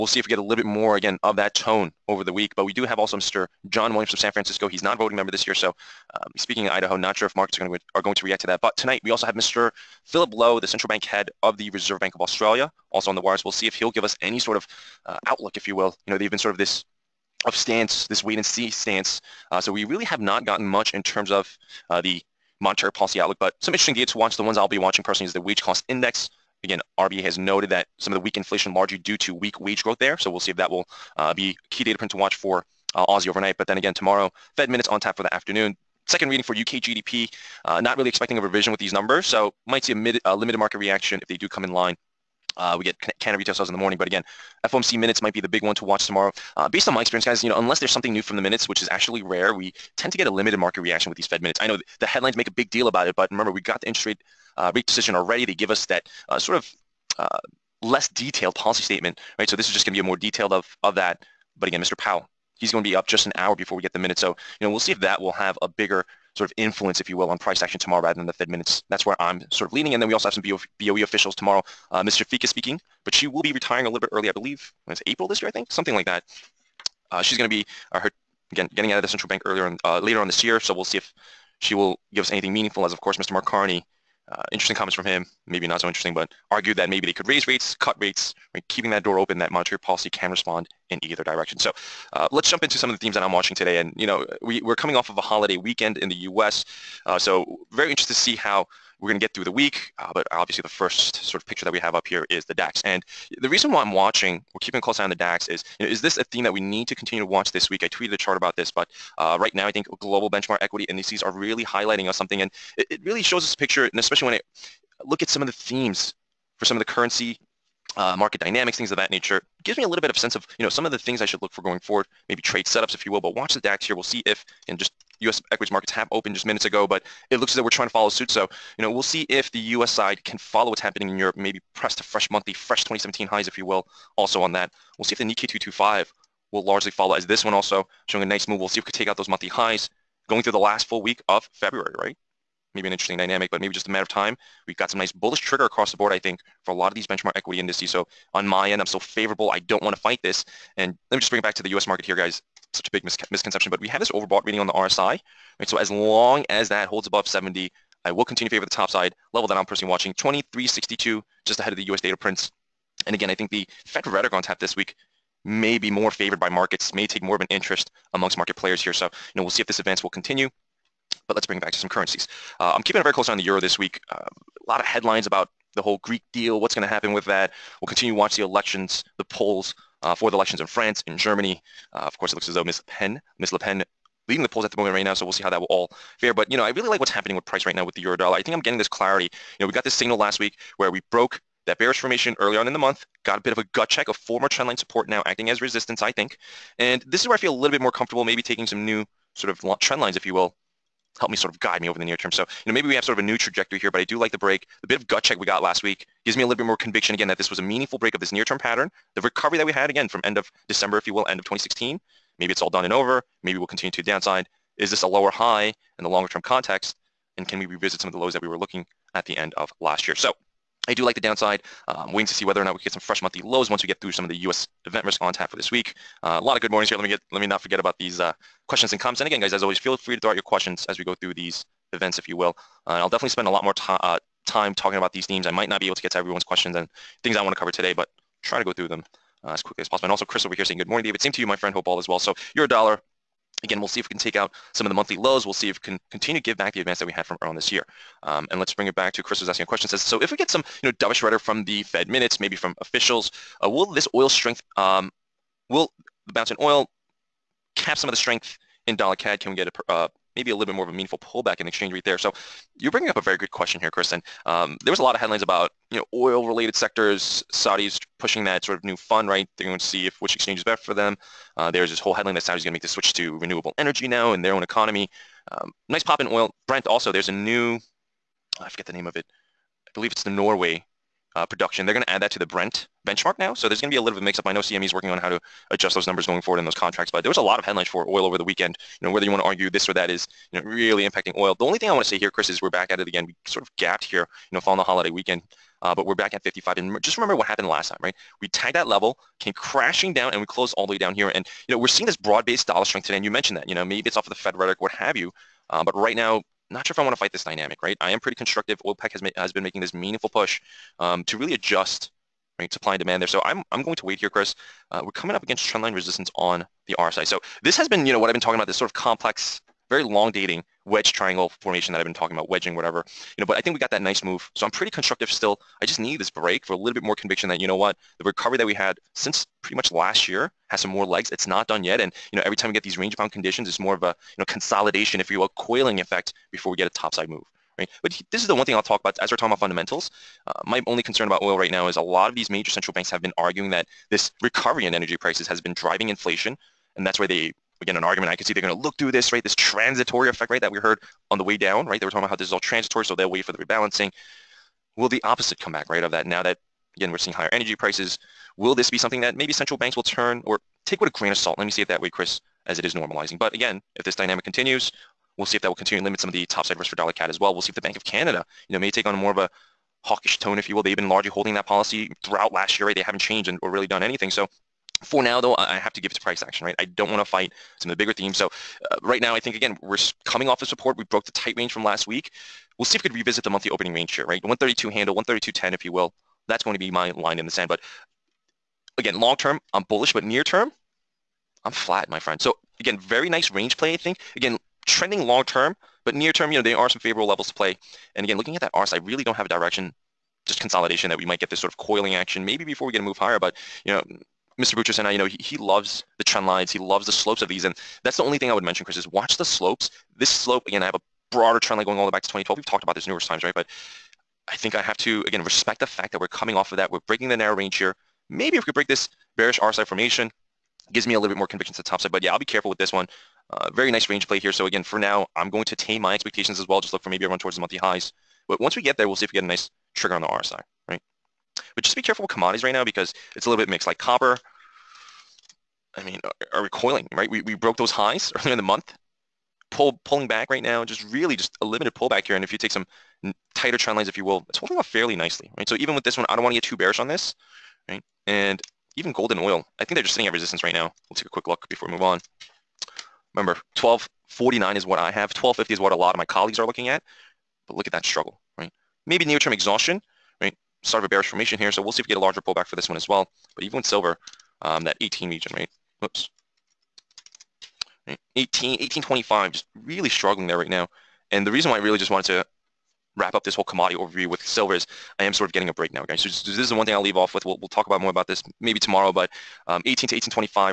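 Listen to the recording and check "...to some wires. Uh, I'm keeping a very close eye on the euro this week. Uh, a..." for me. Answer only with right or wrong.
wrong.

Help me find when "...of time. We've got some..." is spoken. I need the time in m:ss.
2:24.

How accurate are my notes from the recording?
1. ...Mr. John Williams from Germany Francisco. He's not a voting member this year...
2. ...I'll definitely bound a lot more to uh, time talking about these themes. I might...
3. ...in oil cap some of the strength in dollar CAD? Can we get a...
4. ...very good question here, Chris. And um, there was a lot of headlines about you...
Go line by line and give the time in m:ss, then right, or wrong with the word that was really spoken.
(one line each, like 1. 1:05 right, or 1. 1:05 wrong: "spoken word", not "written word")
1. 0:03 wrong: "San", not "Germany"
2. 3:52 wrong: "spend", not "bound"
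3. 4:16 right
4. 4:23 right.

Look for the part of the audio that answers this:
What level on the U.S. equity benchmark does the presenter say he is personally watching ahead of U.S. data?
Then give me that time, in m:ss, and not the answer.
2:40.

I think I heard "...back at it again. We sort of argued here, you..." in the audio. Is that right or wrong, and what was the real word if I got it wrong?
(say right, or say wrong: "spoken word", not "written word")
wrong: "gapped", not "argued".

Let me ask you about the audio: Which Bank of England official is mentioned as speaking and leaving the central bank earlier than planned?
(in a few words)
Shafik.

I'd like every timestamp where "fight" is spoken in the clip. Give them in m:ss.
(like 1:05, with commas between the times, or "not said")
2:29, 5:07, 6:17.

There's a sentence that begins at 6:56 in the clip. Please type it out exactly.
We're breaking the narrow range here.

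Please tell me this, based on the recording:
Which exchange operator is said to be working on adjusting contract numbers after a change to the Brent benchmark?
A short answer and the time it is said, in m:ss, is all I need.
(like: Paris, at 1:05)
CME, at 4:44.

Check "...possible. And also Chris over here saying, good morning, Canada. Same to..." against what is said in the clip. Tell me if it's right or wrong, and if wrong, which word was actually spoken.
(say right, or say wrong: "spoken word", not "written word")
wrong: "David", not "Canada".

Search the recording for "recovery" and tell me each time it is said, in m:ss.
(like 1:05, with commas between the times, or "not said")
3:29, 5:28, 5:44.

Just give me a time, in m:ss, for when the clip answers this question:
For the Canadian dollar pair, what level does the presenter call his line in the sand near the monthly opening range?
6:25.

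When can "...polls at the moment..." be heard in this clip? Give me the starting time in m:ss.
3:04.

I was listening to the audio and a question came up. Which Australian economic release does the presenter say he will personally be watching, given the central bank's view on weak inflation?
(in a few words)
wage cost index.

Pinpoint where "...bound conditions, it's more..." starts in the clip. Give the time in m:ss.
5:33.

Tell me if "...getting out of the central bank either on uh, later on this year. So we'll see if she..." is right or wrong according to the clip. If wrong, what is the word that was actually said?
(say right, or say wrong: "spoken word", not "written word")
wrong: "earlier", not "either".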